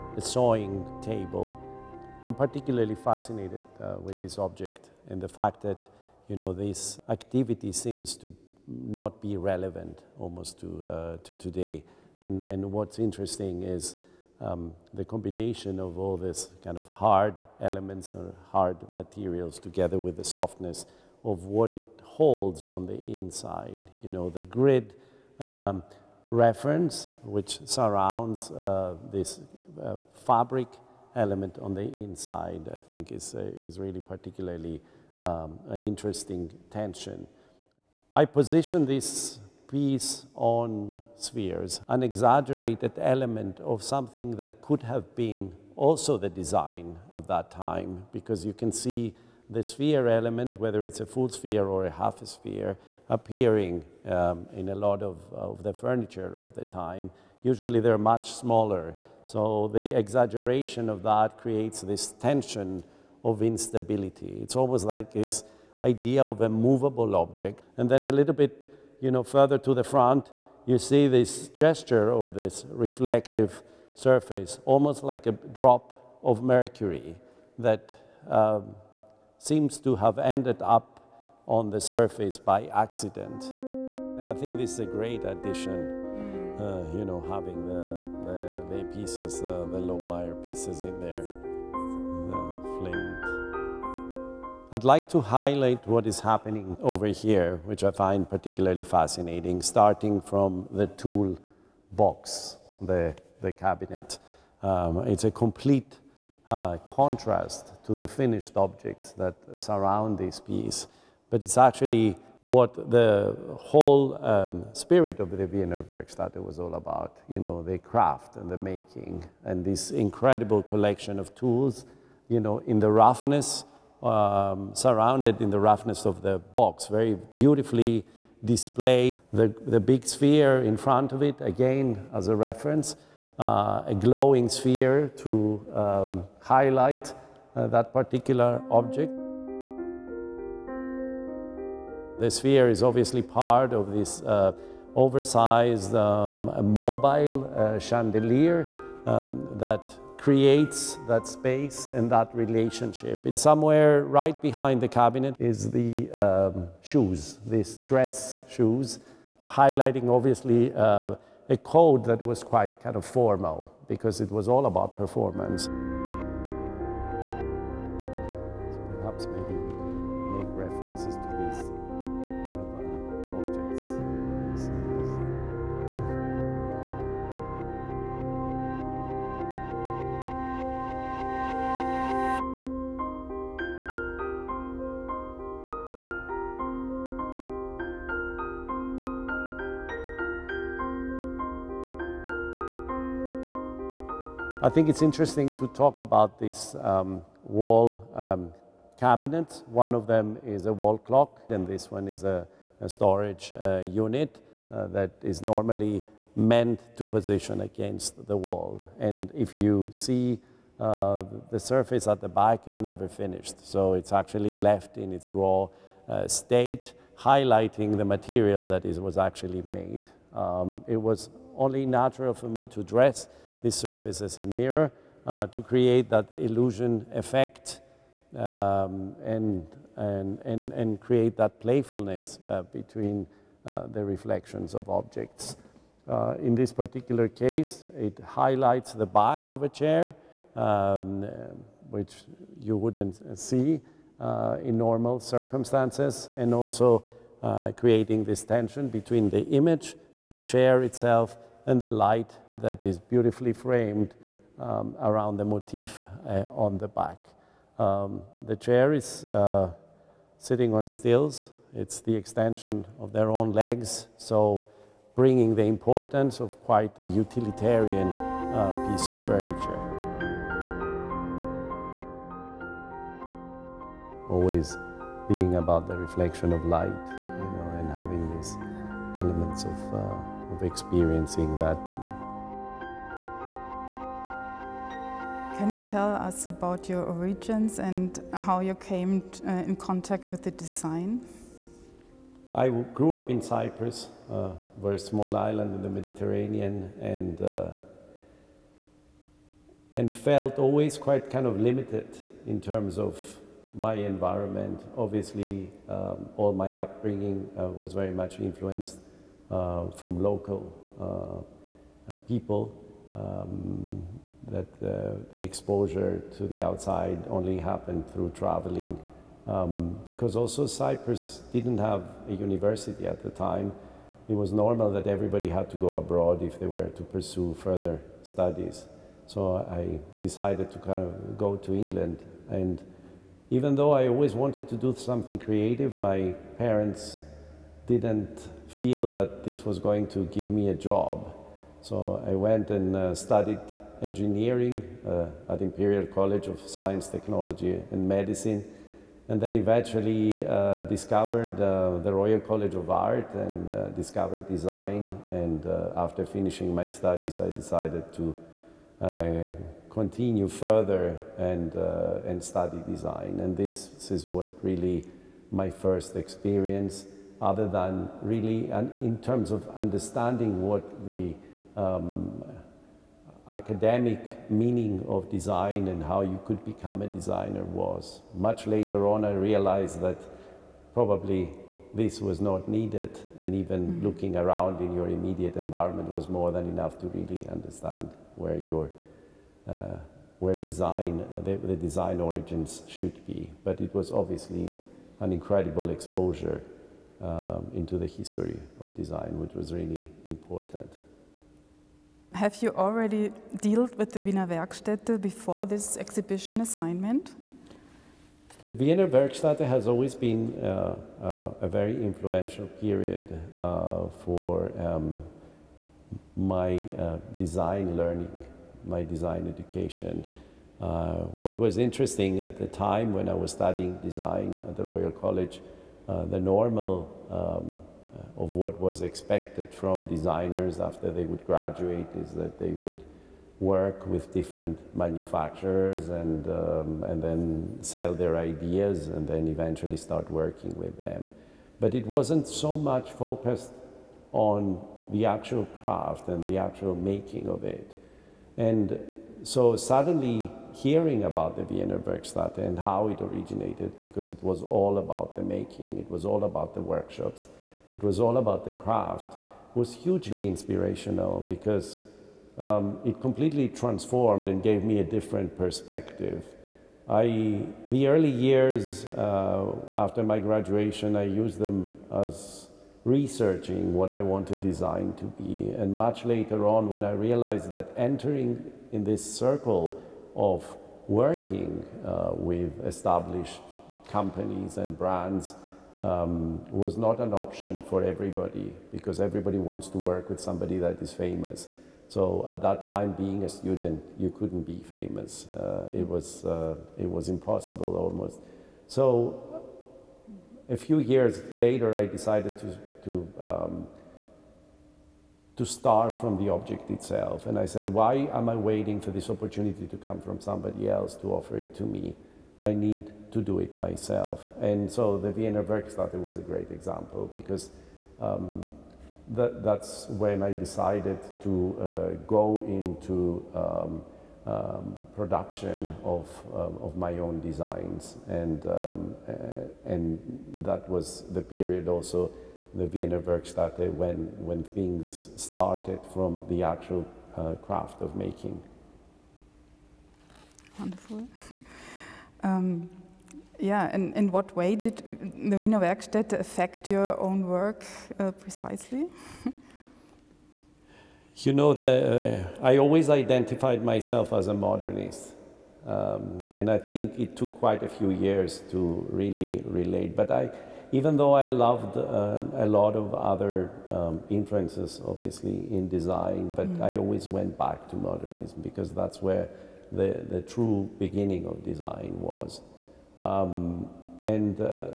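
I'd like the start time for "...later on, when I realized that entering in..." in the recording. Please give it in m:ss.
7:56.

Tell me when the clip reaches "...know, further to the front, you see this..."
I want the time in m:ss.
1:09.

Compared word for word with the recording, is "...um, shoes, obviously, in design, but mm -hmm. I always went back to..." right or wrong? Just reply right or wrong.
wrong.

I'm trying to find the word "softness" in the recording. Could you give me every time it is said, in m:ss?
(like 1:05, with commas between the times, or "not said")
0:20.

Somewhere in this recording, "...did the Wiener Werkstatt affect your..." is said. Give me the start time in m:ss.
9:04.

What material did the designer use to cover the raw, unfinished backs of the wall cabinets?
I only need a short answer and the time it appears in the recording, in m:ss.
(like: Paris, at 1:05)
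mirror, at 3:44.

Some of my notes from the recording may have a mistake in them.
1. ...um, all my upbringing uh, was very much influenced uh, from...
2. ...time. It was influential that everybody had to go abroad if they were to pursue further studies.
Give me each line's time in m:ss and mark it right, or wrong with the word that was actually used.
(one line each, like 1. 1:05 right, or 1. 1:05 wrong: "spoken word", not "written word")
1. 5:05 right
2. 5:23 wrong: "normal", not "influential".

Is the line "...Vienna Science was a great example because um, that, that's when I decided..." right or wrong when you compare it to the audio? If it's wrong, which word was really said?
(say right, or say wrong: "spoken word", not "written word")
wrong: "Werkstatt", not "Science".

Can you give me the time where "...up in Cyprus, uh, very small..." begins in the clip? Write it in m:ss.
4:53.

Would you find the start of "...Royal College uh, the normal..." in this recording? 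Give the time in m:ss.
7:04.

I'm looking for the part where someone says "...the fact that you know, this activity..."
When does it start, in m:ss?
0:05.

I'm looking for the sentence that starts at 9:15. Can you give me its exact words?
Um, and I think it took quite a few years to really relate.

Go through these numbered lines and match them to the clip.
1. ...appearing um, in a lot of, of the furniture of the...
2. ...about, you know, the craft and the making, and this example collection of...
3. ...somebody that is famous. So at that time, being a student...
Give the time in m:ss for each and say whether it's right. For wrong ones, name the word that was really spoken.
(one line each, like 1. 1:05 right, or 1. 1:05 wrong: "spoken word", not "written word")
1. 0:53 right
2. 1:56 wrong: "incredible", not "example"
3. 8:10 right.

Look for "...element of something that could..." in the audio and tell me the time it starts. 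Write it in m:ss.
0:43.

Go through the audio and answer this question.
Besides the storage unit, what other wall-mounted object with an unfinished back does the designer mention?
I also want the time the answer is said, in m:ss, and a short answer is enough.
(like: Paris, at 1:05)
wall clock, at 3:20.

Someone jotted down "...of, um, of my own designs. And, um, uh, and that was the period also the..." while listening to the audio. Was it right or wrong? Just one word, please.
right.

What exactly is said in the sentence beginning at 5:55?
And uh, after finishing my studies, I decided to continue further and, and study design.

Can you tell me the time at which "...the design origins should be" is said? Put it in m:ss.
6:31.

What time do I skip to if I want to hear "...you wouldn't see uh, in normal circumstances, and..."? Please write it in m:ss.
4:02.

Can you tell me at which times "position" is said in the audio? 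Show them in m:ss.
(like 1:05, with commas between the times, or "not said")
0:38, 3:27.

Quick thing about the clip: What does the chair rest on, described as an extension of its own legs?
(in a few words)
stills.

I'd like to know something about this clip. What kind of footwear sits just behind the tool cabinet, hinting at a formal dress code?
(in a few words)
dress shoes.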